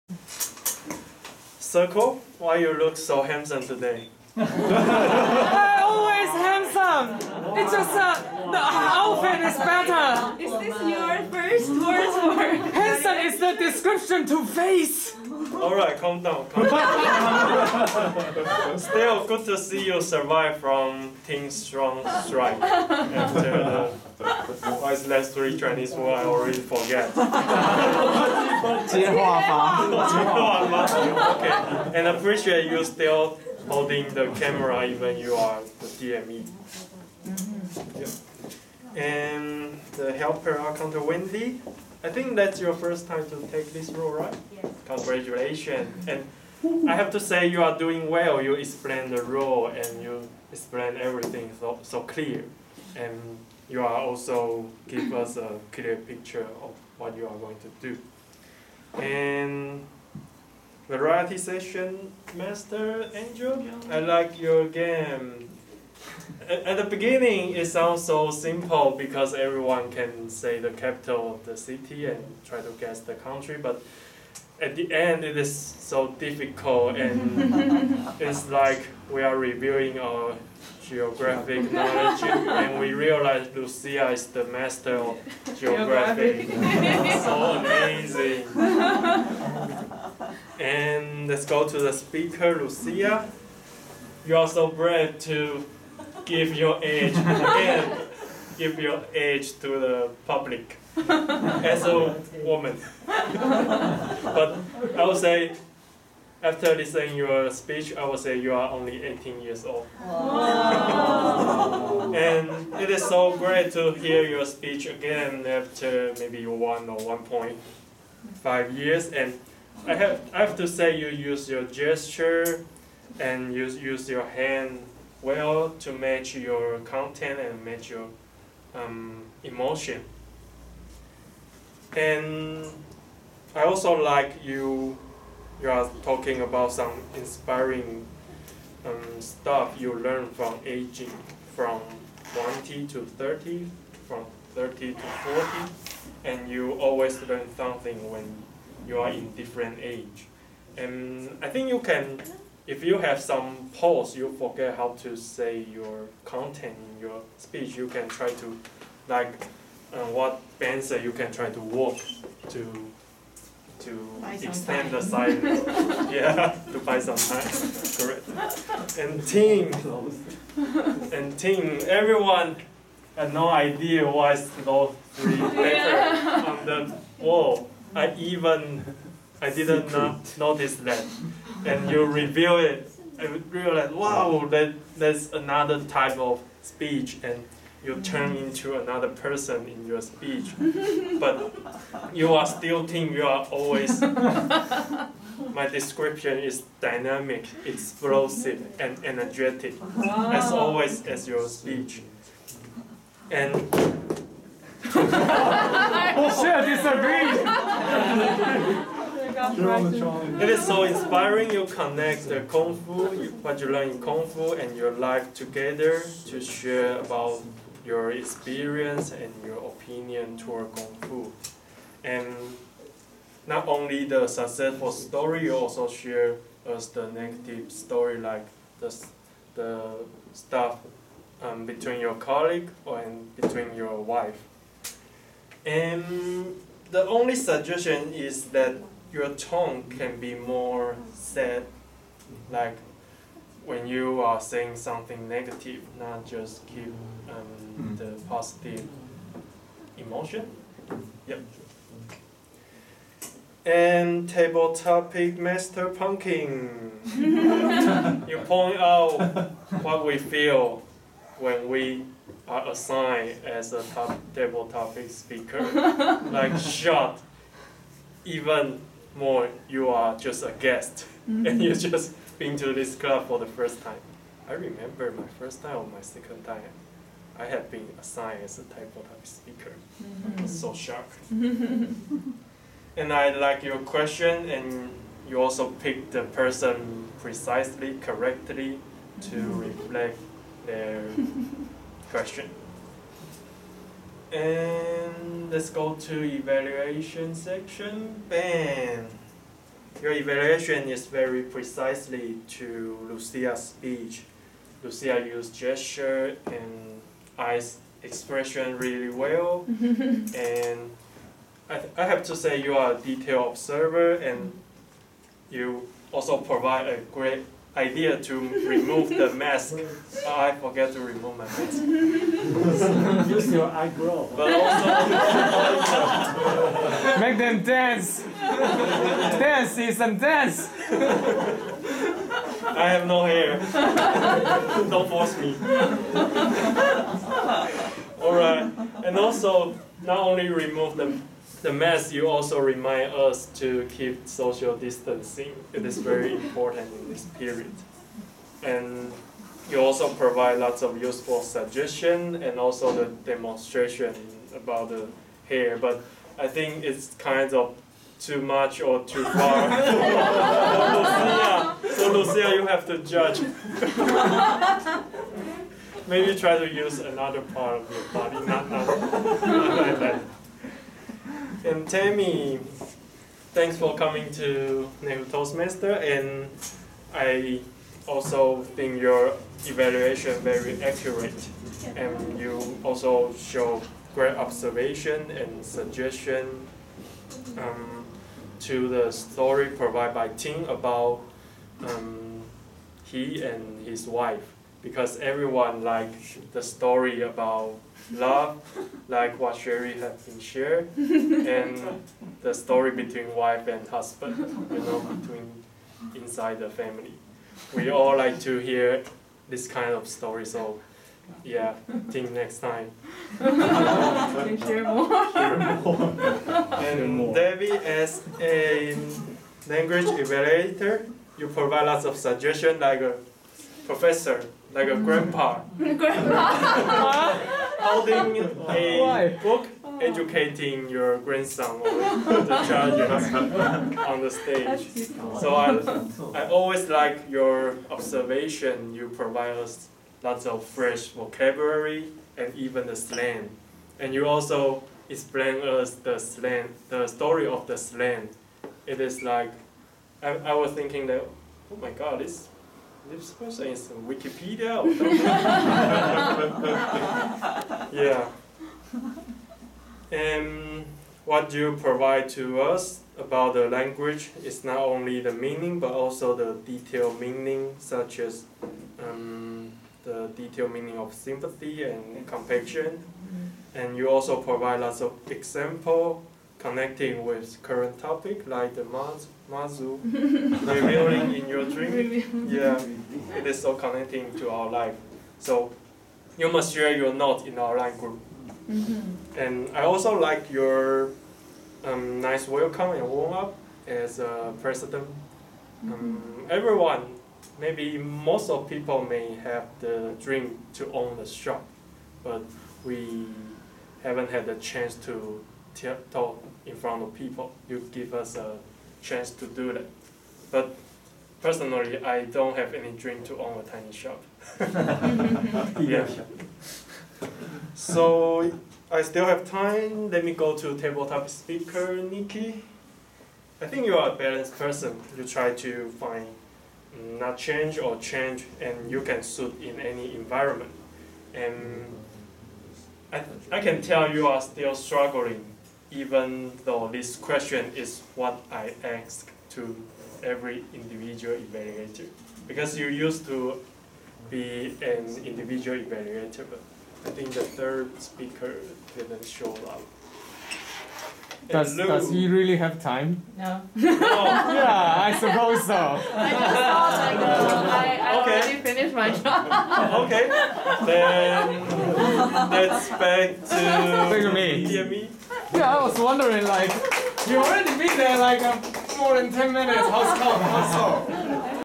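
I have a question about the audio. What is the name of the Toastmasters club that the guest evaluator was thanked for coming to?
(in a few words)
Neihu Toastmaster.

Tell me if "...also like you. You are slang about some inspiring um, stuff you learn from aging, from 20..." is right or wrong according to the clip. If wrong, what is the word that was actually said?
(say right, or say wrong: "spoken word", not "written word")
wrong: "talking", not "slang".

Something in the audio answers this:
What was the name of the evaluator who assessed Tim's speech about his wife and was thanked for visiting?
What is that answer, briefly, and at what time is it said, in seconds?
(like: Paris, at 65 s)
Tammy, at 371 s.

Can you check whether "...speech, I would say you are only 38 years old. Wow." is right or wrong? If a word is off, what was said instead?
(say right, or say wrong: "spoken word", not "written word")
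wrong: "18", not "38".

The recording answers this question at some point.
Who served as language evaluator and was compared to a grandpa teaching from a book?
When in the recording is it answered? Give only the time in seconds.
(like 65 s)
417 s.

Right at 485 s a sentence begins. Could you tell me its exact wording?
So you must share your note in our line group.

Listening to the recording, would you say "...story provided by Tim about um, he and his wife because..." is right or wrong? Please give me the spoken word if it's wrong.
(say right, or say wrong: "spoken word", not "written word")
right.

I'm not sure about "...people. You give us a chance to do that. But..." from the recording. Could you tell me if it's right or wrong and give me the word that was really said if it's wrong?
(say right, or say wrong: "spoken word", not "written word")
right.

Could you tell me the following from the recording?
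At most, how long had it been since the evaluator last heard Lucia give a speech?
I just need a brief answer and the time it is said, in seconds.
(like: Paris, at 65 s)
1.5 years, at 116 s.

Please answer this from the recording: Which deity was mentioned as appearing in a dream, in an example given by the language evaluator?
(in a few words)
Mazu.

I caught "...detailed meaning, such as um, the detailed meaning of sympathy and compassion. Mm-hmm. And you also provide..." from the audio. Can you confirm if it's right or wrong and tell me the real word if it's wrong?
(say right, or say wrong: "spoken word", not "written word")
right.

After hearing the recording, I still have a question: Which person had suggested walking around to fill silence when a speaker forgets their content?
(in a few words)
Ben.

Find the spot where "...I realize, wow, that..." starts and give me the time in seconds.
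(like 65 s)
183 s.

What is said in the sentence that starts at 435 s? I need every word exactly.
So I, I always like your observation.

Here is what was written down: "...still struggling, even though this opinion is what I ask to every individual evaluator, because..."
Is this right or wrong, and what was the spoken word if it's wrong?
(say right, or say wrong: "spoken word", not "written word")
wrong: "question", not "opinion".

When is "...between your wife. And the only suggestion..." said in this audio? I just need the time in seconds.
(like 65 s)
233 s.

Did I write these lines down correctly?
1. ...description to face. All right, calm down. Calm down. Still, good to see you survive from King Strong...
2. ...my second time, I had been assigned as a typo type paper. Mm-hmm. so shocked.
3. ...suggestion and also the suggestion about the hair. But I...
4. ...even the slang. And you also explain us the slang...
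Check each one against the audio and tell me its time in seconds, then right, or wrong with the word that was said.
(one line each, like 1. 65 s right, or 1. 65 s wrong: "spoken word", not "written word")
1. 13 s right
2. 275 s wrong: "speaker", not "paper"
3. 351 s wrong: "demonstration", not "suggestion"
4. 442 s right.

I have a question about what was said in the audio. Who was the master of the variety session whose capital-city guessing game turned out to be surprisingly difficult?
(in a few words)
Angel.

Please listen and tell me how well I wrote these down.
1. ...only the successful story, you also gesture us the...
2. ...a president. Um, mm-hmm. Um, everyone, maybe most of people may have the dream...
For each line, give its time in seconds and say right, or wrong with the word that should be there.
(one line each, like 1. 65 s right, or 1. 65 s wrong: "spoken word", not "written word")
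1. 223 s wrong: "share", not "gesture"
2. 494 s right.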